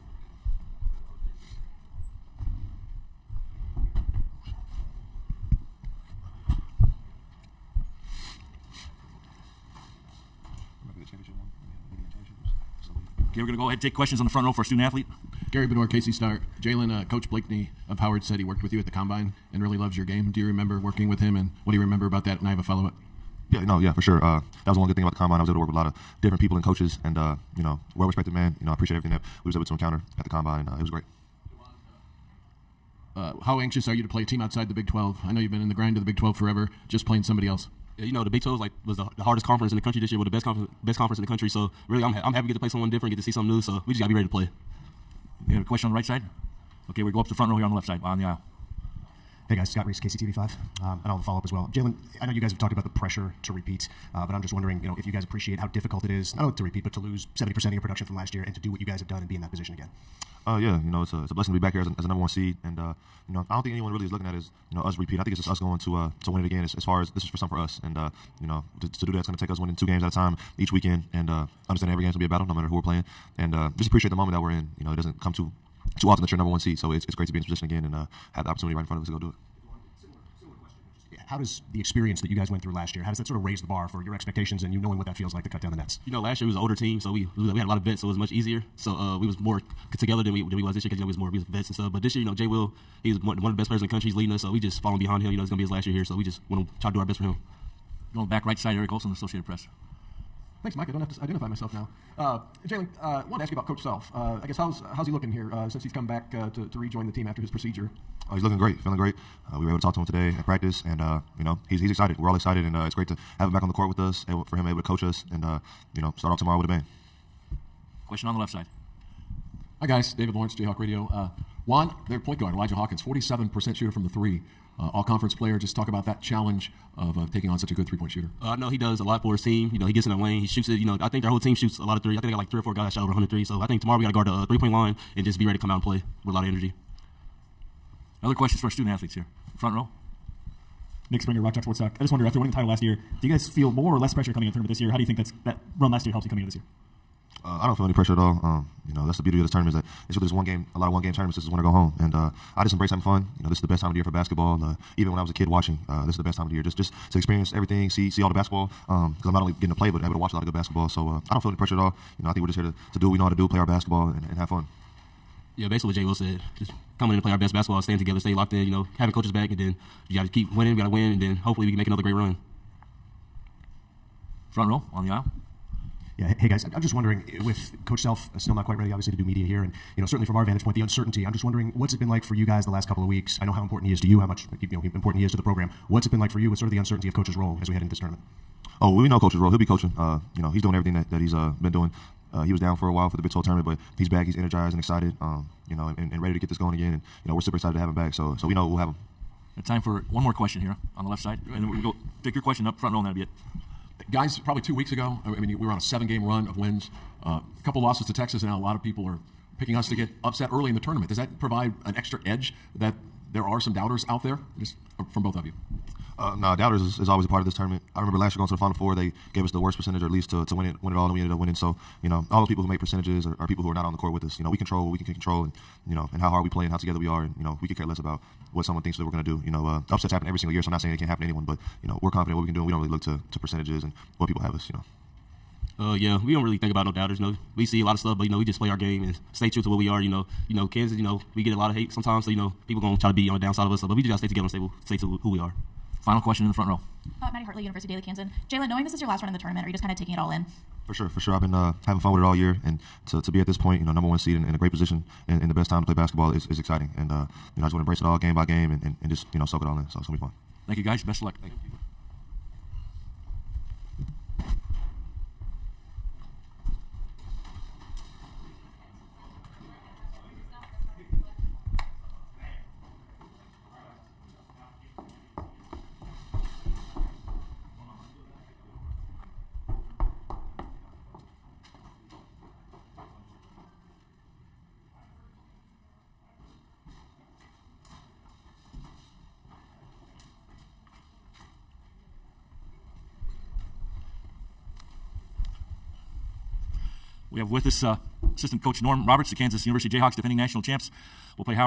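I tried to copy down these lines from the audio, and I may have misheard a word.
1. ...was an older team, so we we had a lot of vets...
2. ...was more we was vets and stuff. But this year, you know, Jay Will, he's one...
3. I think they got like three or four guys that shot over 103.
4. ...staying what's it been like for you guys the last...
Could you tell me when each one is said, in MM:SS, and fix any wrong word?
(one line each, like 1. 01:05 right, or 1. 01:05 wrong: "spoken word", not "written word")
1. 01:26 right
2. 01:31 right
3. 02:12 right
4. 03:01 wrong: "wondering", not "staying".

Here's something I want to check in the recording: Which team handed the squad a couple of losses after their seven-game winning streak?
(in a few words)
Texas.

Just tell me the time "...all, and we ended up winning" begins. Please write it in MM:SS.
03:40.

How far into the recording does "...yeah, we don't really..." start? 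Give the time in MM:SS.
03:55.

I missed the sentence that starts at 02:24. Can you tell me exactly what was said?
How do you think that's that run last year helps you coming into this year?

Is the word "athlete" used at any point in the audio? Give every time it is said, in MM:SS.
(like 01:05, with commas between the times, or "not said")
00:14, 02:18.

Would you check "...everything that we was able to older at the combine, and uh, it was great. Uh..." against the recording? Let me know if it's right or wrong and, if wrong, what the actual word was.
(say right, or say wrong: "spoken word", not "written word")
wrong: "encounter", not "older".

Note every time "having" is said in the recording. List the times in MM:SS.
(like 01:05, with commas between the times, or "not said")
02:32, 02:48, 04:11.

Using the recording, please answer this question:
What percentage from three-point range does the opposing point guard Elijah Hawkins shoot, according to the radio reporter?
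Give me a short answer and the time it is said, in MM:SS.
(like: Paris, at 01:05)
47%, at 02:02.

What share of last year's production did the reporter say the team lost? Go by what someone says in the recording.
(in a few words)
70%.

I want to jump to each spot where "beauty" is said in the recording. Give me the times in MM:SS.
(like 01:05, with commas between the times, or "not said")
02:29.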